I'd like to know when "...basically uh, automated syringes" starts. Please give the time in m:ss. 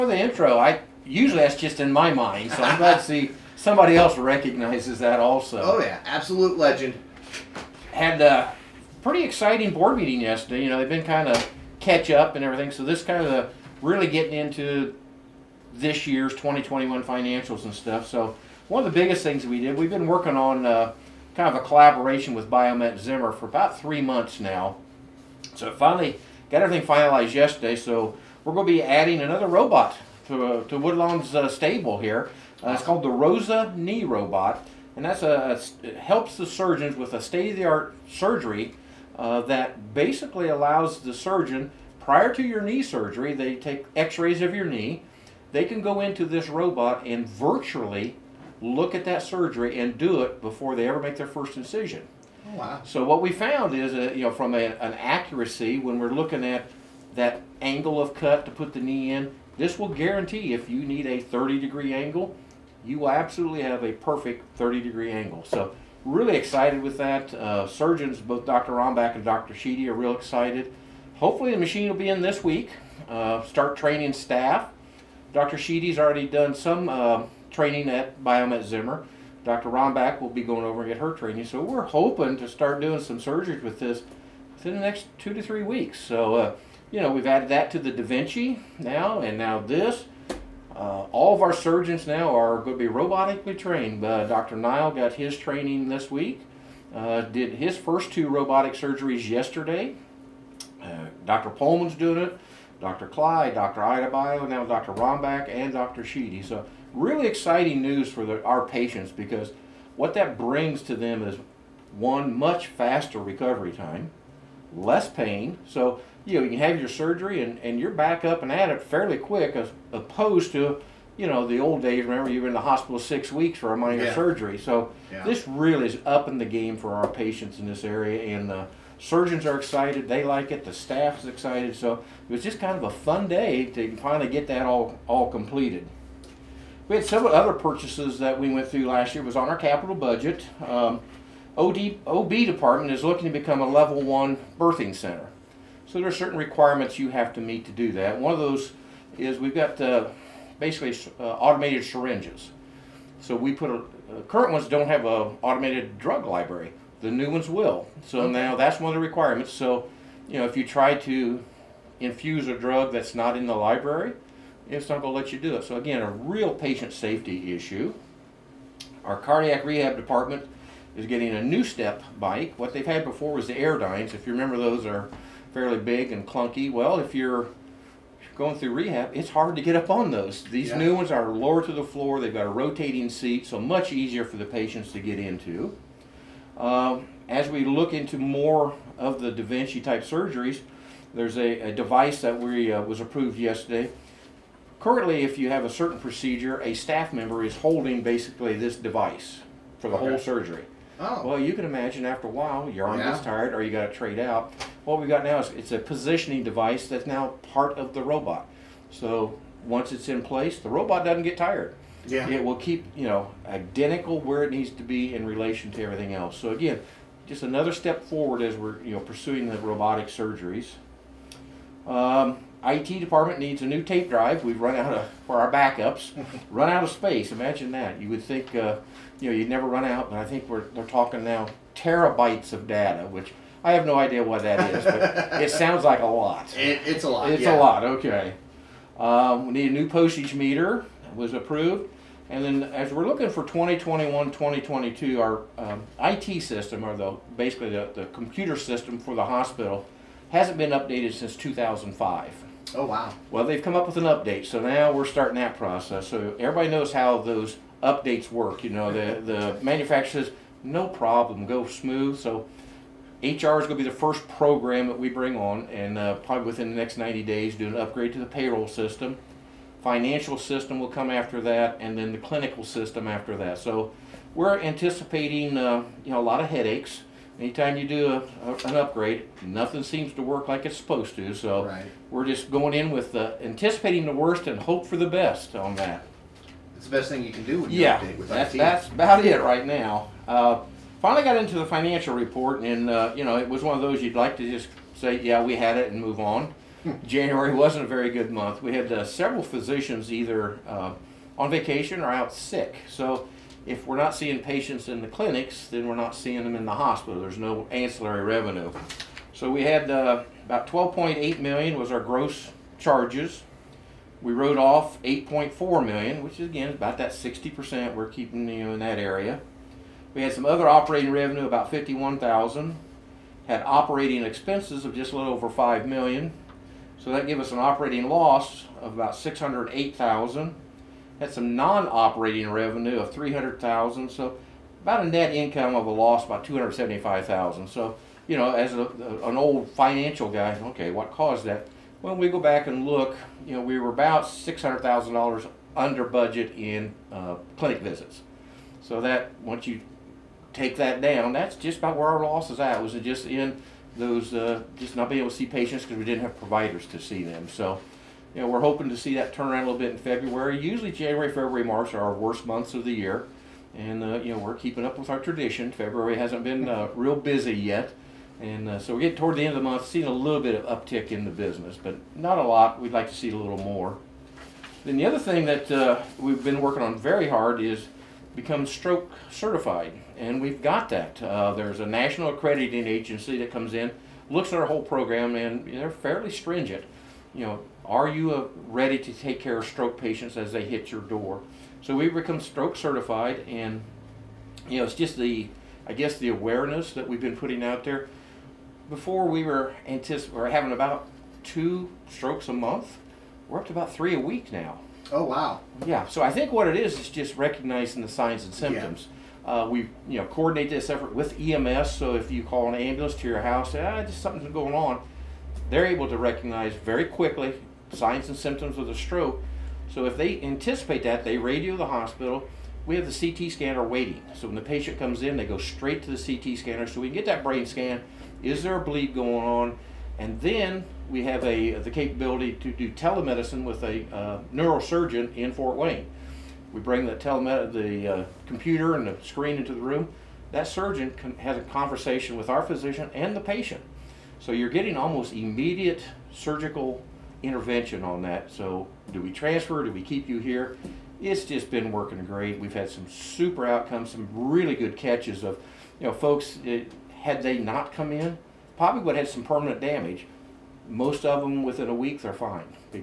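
2:30.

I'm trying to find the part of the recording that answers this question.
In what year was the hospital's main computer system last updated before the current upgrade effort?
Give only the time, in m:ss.
4:11.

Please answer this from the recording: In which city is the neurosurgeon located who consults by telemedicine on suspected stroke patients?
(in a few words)
Fort Wayne.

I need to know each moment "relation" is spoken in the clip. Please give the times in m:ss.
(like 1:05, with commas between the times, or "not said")
3:35.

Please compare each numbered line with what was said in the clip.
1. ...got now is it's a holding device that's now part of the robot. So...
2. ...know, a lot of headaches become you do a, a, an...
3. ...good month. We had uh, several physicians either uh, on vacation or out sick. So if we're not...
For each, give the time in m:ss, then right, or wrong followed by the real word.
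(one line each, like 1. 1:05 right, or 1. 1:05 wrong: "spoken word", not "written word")
1. 3:25 wrong: "positioning", not "holding"
2. 4:36 wrong: "anytime", not "become"
3. 4:58 right.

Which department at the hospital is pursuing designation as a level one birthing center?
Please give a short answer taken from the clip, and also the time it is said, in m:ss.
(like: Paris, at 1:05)
OB department, at 2:22.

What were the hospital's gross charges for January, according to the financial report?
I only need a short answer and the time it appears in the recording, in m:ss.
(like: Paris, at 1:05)
$12.8 million, at 5:10.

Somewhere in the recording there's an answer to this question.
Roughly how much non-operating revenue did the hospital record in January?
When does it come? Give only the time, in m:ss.
5:33.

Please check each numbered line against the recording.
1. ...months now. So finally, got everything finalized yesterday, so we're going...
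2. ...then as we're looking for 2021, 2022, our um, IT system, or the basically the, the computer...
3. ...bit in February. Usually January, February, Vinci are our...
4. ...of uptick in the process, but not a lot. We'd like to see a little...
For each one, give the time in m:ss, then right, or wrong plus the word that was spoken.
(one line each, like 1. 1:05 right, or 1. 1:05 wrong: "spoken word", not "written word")
1. 0:24 right
2. 4:02 right
3. 5:59 wrong: "March", not "Vinci"
4. 6:10 wrong: "business", not "process".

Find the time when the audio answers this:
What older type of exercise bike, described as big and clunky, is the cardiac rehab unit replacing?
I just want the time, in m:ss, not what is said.
2:53.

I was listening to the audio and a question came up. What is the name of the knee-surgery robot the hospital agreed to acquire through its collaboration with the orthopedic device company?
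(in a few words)
Rosa Knee Robot.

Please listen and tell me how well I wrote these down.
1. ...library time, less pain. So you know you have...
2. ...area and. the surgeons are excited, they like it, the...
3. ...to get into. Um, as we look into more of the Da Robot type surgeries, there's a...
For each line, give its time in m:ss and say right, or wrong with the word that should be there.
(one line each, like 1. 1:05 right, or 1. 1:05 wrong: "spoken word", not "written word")
1. 1:53 wrong: "recovery", not "library"
2. 2:07 right
3. 3:04 wrong: "Vinci", not "Robot".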